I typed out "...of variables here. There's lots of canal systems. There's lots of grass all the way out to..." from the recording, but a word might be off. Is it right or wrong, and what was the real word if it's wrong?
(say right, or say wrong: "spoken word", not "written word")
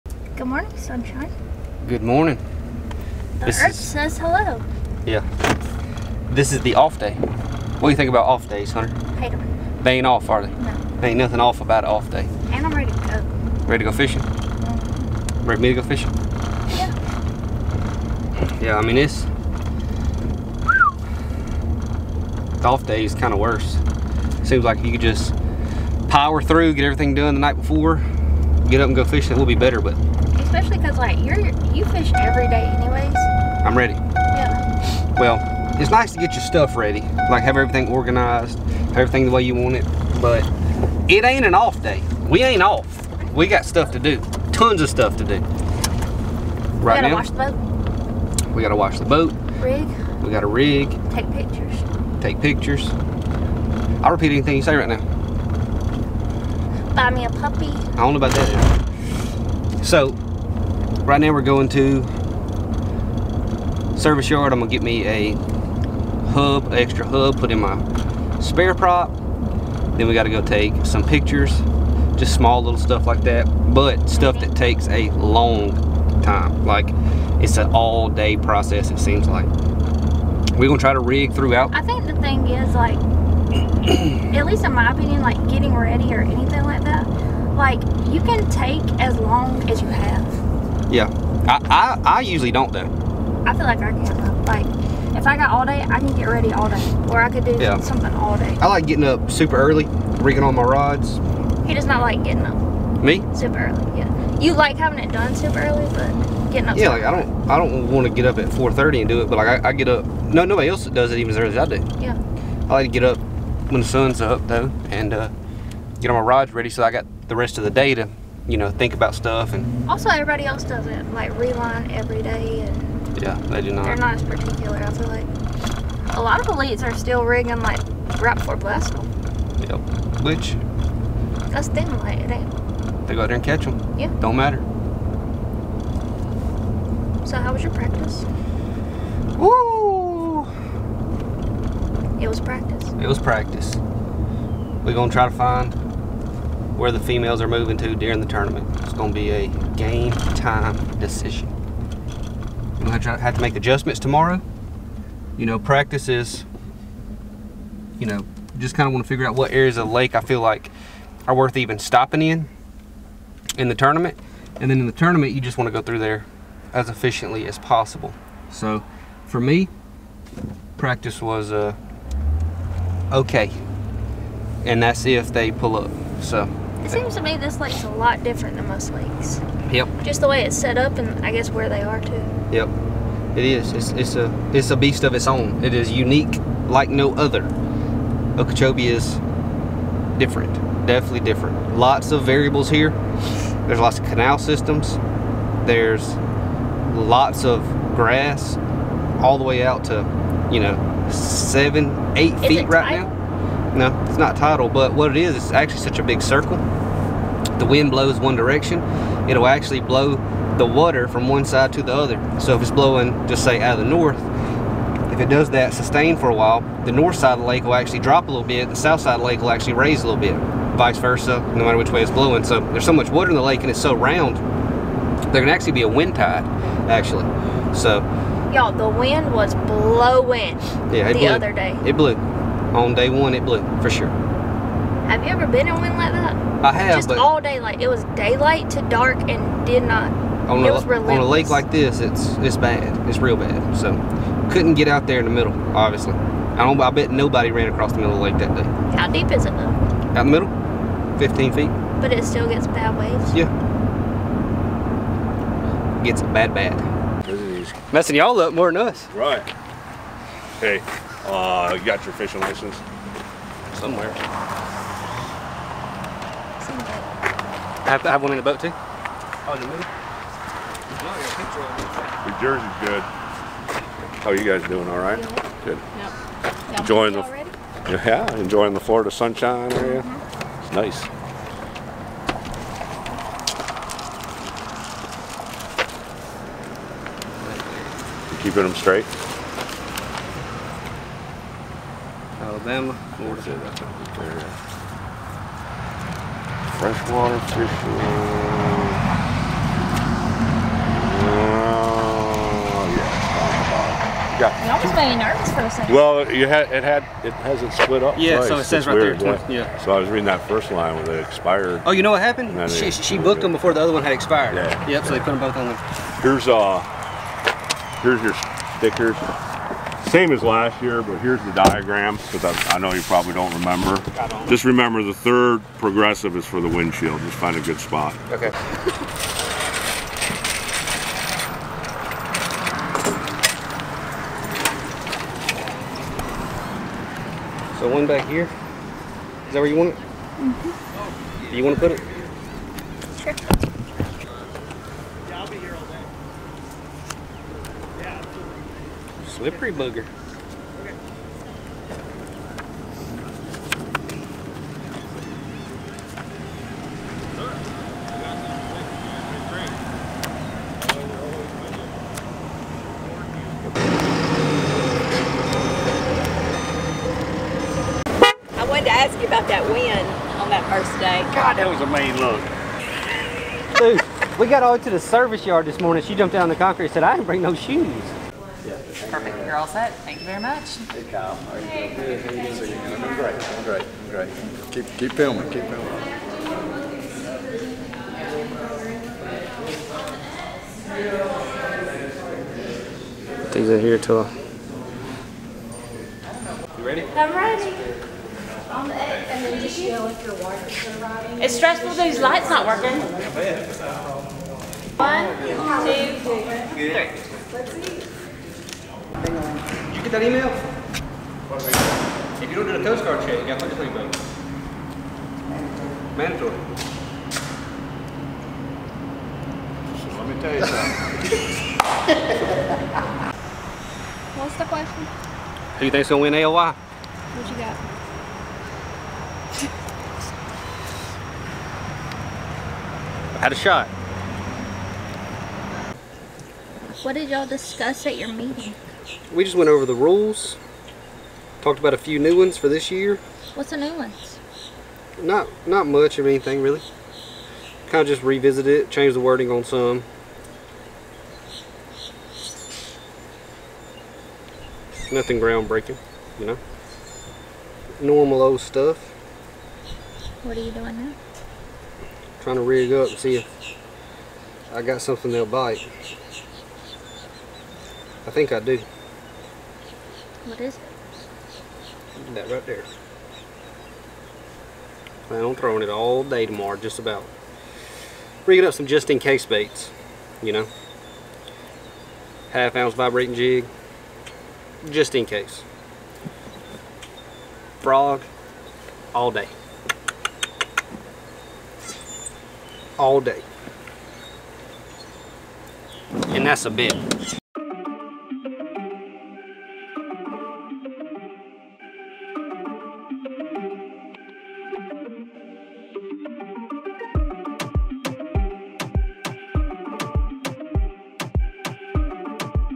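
right.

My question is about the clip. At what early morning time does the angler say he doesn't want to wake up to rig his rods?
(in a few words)
4:30.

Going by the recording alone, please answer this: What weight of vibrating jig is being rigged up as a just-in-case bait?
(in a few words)
Half ounce.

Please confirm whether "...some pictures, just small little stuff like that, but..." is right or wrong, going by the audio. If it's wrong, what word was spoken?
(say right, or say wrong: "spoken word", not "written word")
right.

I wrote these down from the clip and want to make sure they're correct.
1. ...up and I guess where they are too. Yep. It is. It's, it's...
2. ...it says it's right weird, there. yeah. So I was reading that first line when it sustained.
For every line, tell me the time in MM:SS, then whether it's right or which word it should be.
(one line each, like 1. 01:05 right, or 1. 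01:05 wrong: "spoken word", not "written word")
1. 03:00 right
2. 05:08 wrong: "expired", not "sustained".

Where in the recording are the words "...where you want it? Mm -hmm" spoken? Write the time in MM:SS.
05:39.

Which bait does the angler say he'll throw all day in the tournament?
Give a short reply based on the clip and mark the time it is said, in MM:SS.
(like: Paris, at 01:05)
Frog, at 08:07.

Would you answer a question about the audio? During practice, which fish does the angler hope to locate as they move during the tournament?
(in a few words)
Females.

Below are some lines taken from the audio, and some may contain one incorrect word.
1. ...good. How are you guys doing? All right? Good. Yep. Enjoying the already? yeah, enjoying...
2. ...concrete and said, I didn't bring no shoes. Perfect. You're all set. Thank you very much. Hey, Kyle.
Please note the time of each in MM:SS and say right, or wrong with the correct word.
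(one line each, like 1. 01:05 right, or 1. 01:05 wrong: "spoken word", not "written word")
1. 04:32 right
2. 06:16 right.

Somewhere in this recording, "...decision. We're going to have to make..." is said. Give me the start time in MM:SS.
02:30.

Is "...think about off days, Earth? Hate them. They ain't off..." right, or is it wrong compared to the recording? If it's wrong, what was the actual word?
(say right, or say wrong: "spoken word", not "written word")
wrong: "Hunter", not "Earth".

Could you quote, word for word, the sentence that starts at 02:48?
So for me, practice was uh, okay.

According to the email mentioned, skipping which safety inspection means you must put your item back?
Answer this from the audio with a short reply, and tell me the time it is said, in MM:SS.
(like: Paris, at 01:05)
Coast Guard check, at 06:52.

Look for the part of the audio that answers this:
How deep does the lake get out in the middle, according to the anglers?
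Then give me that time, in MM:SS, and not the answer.
04:11.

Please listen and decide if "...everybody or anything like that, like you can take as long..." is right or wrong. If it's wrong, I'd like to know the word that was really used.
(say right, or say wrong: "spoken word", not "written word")
wrong: "ready", not "everybody".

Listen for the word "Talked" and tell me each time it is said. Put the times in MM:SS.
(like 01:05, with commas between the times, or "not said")
07:21.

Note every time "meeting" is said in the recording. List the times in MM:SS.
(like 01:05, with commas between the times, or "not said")
07:18.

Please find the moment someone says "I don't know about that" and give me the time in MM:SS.
00:57.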